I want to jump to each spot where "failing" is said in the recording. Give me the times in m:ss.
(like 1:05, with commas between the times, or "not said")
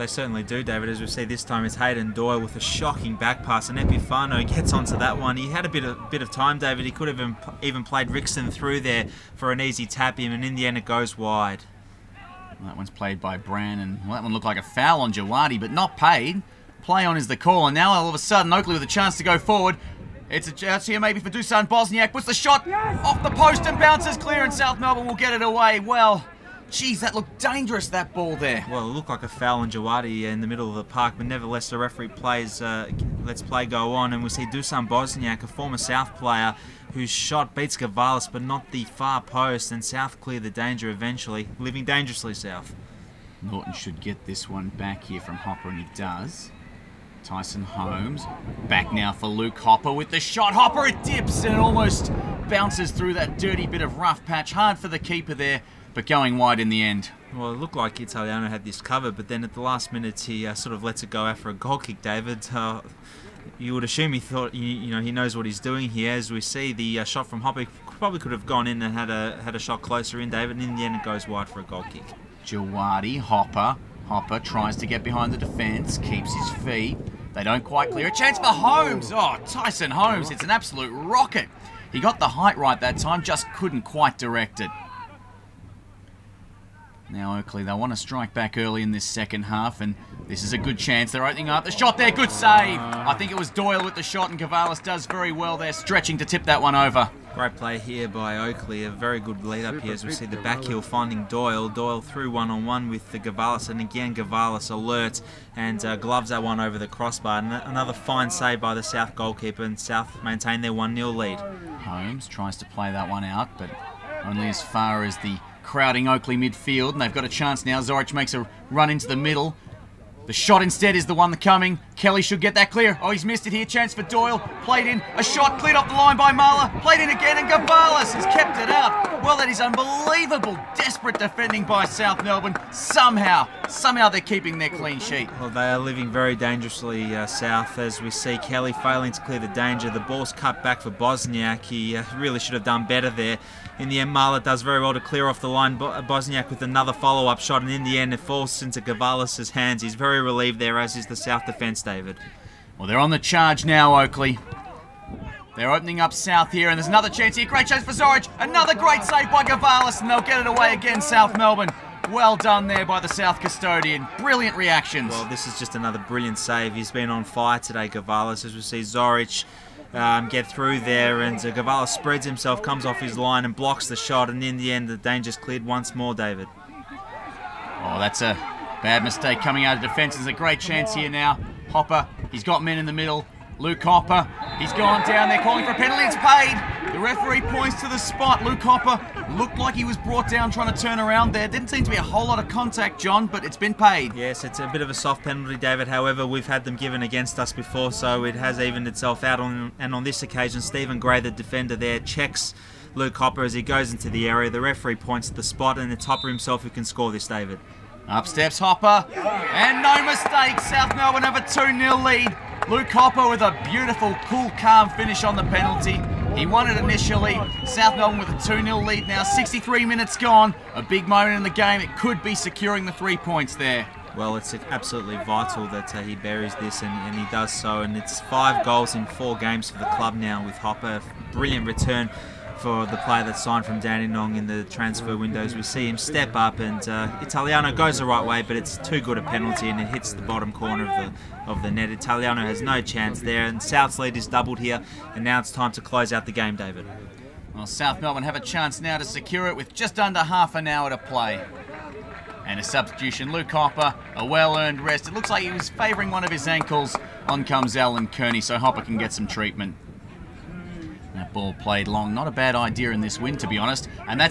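2:18.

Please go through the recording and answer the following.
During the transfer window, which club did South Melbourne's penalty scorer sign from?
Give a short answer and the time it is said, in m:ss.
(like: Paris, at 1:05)
Dandenong, at 3:53.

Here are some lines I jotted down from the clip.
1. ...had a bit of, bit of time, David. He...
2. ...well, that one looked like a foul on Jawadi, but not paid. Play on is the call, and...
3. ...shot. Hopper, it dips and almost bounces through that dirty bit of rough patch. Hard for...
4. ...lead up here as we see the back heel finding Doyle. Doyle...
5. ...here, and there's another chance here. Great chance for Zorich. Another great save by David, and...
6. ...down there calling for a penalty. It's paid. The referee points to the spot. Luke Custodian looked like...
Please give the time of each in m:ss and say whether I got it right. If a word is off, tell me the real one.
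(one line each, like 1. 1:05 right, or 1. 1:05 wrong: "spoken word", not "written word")
1. 0:05 right
2. 0:14 right
3. 0:50 right
4. 1:39 right
5. 2:36 wrong: "Gavalis", not "David"
6. 3:05 wrong: "Hopper", not "Custodian".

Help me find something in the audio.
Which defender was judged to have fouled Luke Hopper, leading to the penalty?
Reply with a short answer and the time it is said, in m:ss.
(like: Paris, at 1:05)
Stephen Gray, at 3:20.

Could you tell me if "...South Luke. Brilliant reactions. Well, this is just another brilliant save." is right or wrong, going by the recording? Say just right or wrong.
wrong.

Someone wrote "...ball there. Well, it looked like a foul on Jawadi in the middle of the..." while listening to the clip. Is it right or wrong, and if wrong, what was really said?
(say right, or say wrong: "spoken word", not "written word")
right.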